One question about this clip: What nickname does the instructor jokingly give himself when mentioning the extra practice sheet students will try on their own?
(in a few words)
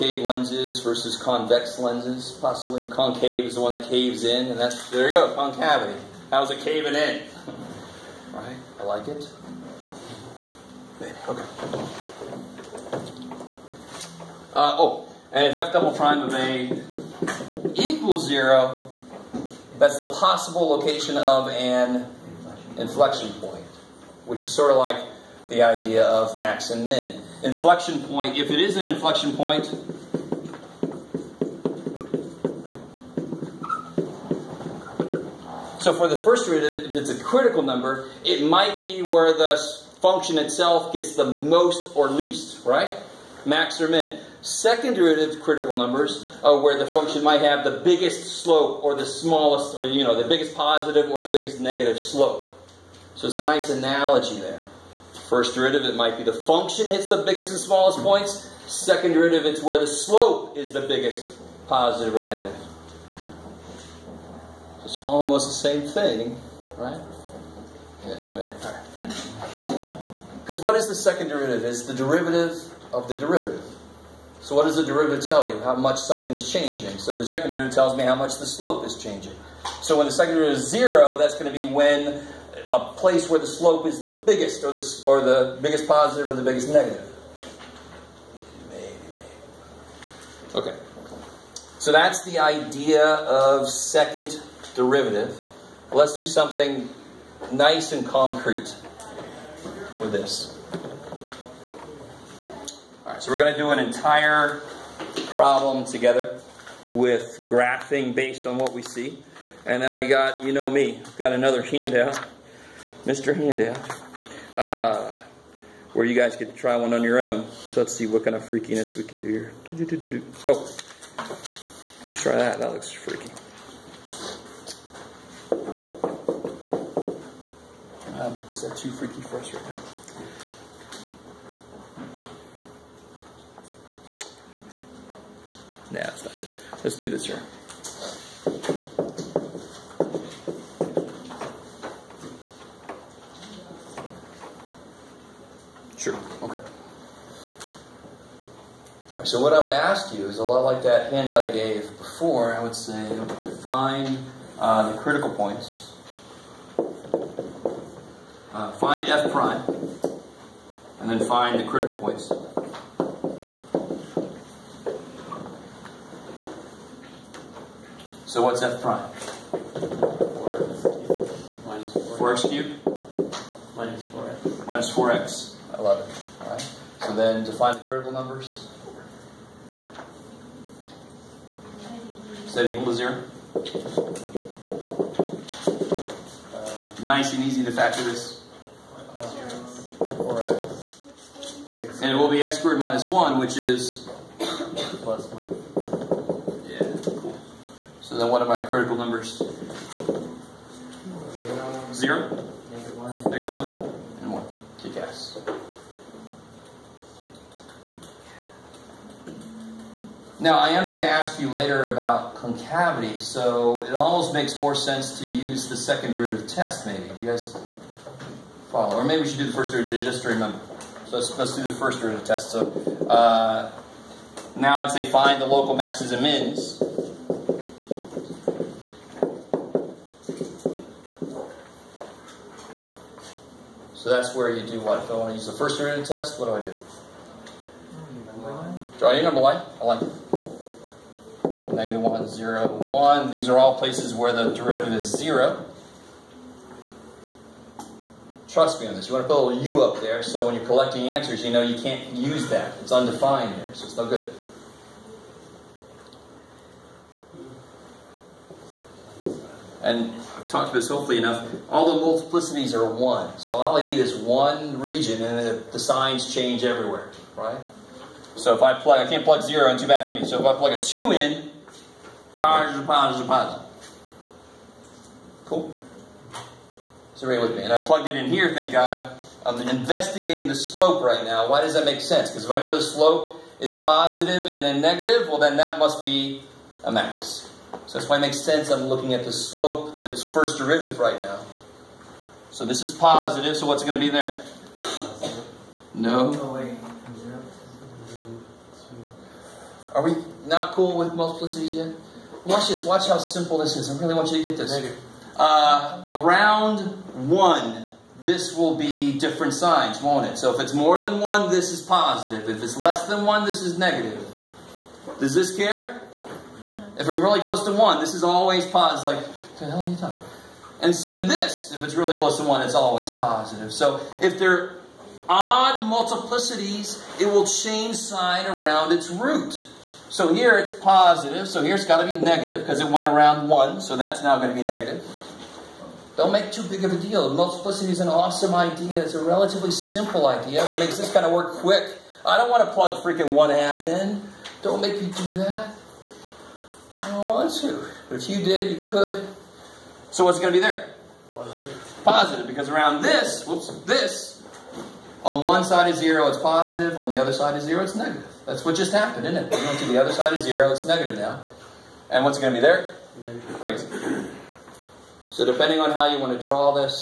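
Mr. Handout.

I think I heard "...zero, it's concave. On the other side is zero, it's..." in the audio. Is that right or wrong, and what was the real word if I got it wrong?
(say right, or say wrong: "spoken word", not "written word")
wrong: "positive", not "concave".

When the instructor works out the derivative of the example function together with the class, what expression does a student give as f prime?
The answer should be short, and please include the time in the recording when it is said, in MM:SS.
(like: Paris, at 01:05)
4x cubed minus 4x, at 02:49.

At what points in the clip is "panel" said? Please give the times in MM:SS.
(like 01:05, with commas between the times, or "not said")
not said.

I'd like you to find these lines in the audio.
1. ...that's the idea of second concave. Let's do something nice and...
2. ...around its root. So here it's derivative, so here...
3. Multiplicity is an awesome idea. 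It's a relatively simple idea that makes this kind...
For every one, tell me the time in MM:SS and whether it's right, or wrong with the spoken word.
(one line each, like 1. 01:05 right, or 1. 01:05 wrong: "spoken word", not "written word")
1. 01:31 wrong: "derivative", not "concave"
2. 05:28 wrong: "positive", not "derivative"
3. 05:37 right.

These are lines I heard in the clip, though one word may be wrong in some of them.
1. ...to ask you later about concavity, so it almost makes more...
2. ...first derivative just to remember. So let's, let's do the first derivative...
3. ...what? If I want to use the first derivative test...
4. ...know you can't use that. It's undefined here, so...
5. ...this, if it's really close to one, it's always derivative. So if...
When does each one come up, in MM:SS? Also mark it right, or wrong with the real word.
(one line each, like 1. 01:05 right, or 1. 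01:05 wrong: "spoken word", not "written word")
1. 03:30 right
2. 03:39 right
3. 03:54 right
4. 04:11 right
5. 05:21 wrong: "positive", not "derivative".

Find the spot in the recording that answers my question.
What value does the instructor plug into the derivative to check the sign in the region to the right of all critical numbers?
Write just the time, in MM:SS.
04:30.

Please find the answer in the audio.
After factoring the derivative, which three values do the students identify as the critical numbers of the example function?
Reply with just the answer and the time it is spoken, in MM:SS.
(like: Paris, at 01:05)
0, -1 and 1, at 03:21.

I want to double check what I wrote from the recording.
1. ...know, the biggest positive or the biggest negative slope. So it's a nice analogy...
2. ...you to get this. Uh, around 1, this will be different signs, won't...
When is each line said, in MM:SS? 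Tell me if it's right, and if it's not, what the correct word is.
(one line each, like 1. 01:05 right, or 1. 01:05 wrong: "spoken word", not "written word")
1. 00:50 right
2. 05:04 right.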